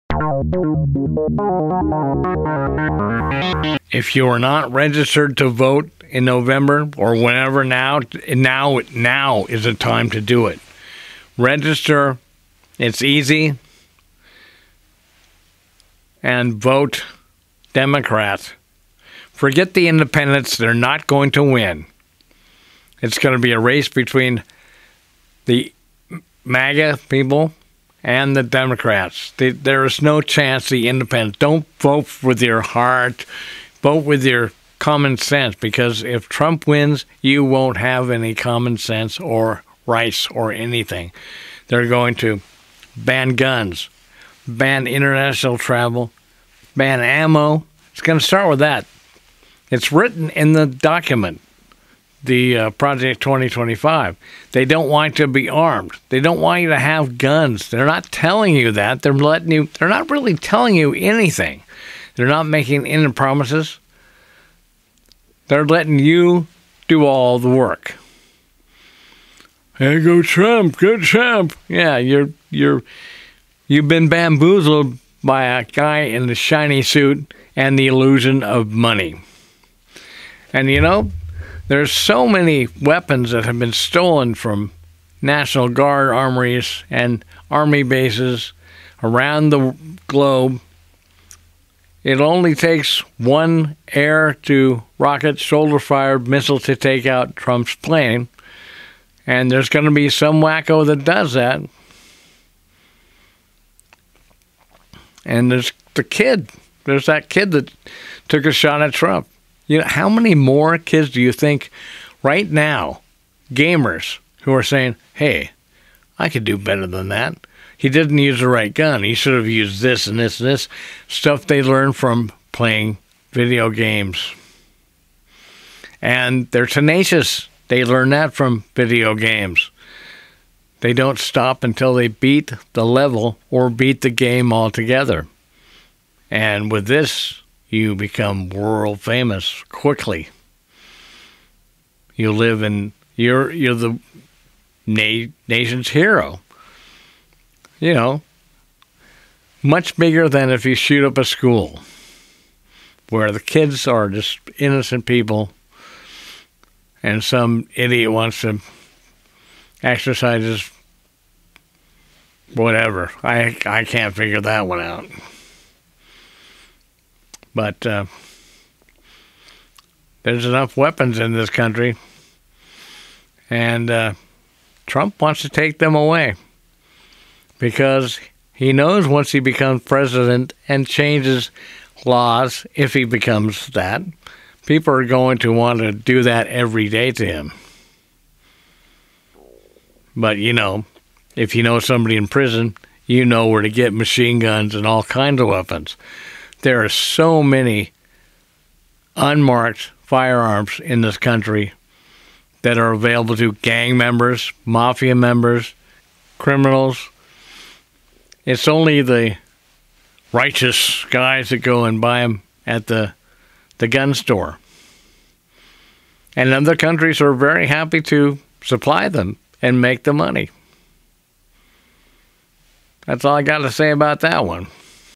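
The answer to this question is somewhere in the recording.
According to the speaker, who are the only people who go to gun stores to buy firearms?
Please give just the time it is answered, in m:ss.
3:30.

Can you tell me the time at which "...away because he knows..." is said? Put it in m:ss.
2:55.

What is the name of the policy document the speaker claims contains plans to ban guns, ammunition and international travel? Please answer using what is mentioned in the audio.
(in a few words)
Project 2025.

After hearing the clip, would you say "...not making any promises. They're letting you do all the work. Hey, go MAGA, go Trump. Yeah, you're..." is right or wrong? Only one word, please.
wrong.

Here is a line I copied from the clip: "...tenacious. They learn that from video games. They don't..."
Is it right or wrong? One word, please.
right.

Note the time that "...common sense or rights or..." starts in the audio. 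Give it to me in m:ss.
0:38.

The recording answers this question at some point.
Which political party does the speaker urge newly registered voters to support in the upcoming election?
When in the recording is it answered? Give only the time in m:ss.
0:17.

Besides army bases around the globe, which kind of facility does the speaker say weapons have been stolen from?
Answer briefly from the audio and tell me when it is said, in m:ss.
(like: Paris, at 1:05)
National Guard armories, at 1:25.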